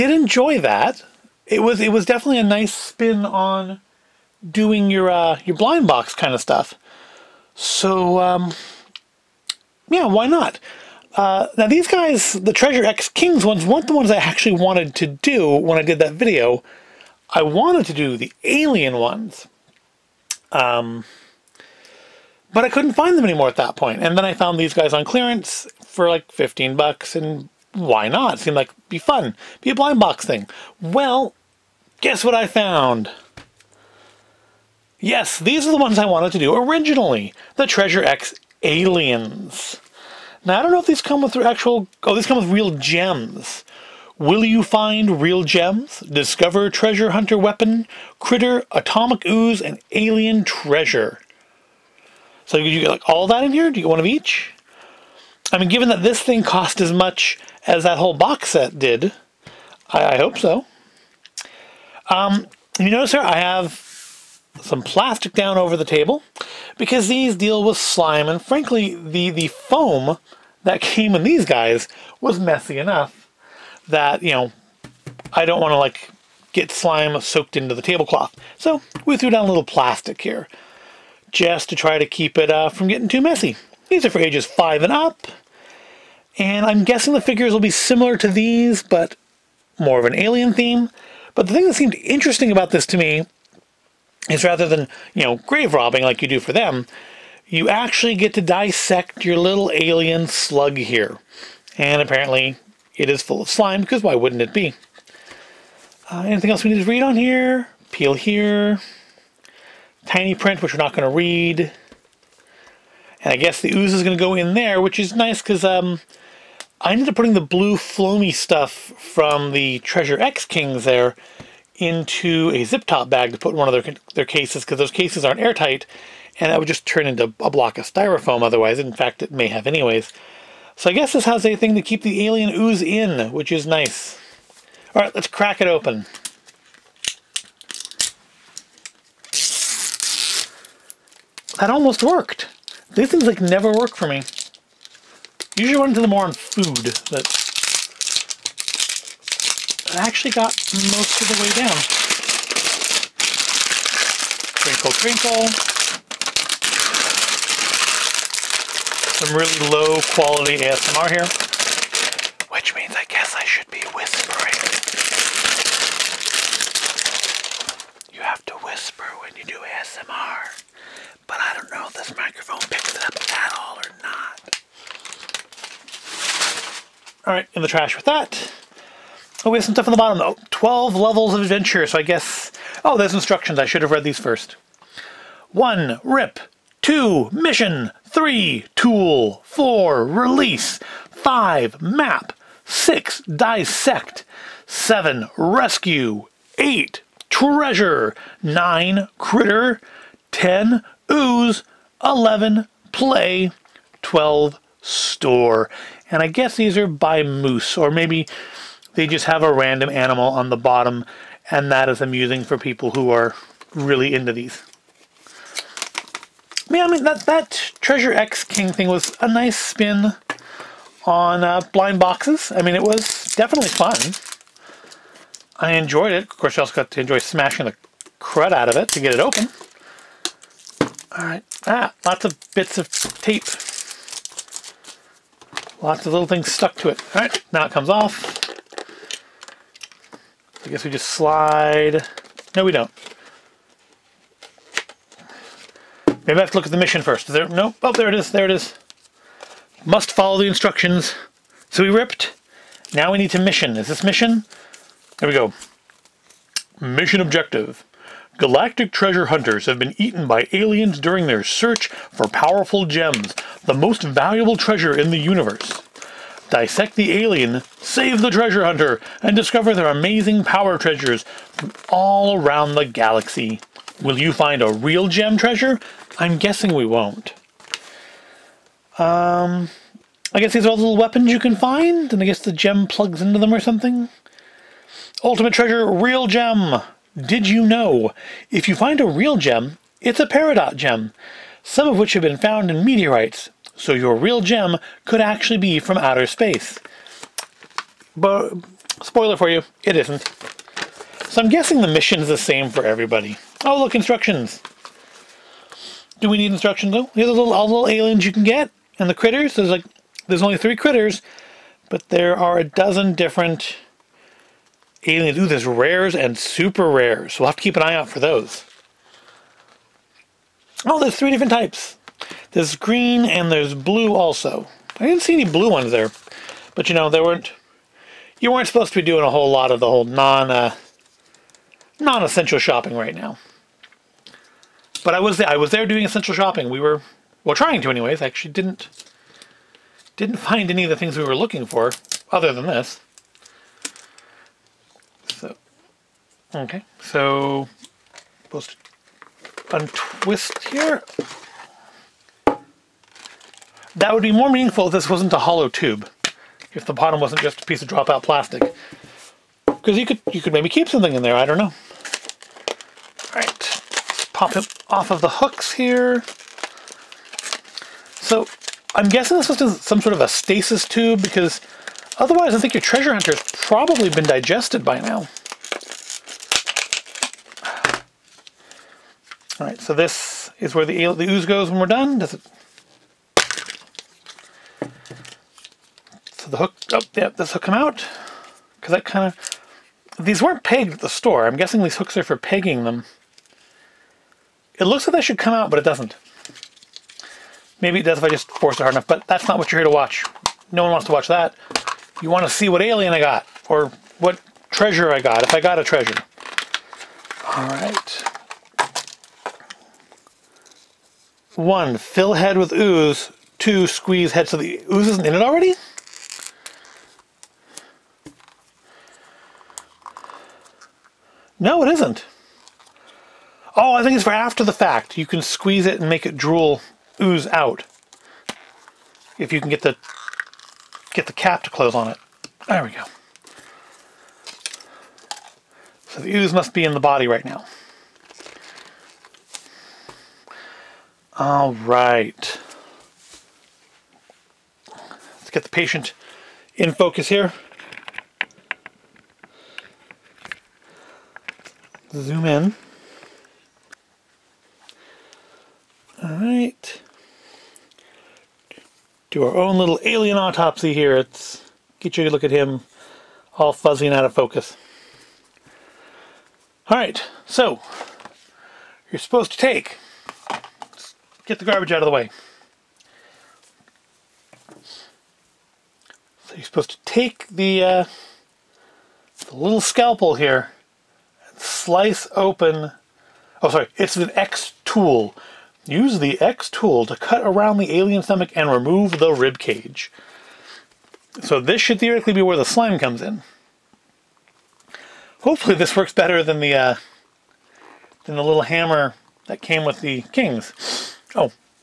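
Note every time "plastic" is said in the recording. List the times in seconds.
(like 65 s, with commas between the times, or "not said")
64 s, 79 s, 358 s.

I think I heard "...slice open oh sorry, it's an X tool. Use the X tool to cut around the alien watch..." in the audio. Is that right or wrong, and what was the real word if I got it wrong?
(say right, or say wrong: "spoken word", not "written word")
wrong: "stomach", not "watch".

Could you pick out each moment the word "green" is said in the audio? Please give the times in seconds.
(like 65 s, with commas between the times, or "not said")
322 s.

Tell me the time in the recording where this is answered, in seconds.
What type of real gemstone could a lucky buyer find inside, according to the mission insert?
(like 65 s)
290 s.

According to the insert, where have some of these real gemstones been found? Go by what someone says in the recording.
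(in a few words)
Meteorites.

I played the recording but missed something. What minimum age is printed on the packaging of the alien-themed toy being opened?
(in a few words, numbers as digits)
5.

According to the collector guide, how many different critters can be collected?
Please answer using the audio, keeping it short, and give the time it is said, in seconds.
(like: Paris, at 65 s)
3, at 310 s.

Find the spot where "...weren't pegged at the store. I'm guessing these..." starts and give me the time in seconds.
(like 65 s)
390 s.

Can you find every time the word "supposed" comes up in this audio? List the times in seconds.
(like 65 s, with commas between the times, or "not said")
328 s, 348 s, 469 s, 476 s.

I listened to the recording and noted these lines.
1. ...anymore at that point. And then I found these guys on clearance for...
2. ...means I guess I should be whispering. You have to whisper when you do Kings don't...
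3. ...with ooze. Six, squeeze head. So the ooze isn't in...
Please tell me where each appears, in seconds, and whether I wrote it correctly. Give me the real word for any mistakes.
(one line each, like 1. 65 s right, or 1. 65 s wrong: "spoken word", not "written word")
1. 23 s right
2. 162 s wrong: "ASMR", not "Kings"
3. 412 s wrong: "Two", not "Six".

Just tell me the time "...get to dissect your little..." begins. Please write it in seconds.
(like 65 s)
98 s.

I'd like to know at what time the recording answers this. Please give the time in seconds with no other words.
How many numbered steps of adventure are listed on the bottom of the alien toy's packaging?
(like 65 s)
180 s.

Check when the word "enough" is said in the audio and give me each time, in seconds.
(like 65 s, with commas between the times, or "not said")
72 s, 398 s.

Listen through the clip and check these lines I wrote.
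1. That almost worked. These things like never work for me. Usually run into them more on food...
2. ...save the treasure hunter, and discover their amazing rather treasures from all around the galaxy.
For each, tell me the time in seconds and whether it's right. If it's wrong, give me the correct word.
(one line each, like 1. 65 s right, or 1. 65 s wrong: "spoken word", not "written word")
1. 141 s right
2. 267 s wrong: "power", not "rather".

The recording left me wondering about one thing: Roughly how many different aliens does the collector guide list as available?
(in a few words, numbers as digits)
A dozen.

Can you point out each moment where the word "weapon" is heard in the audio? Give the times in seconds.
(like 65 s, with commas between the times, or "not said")
47 s, 280 s.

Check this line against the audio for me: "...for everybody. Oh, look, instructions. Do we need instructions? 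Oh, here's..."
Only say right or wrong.
right.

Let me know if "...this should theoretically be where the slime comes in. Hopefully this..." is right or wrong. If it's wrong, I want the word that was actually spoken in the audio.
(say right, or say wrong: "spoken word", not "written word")
right.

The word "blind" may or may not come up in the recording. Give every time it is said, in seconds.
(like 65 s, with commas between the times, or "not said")
5 s, 29 s, 221 s.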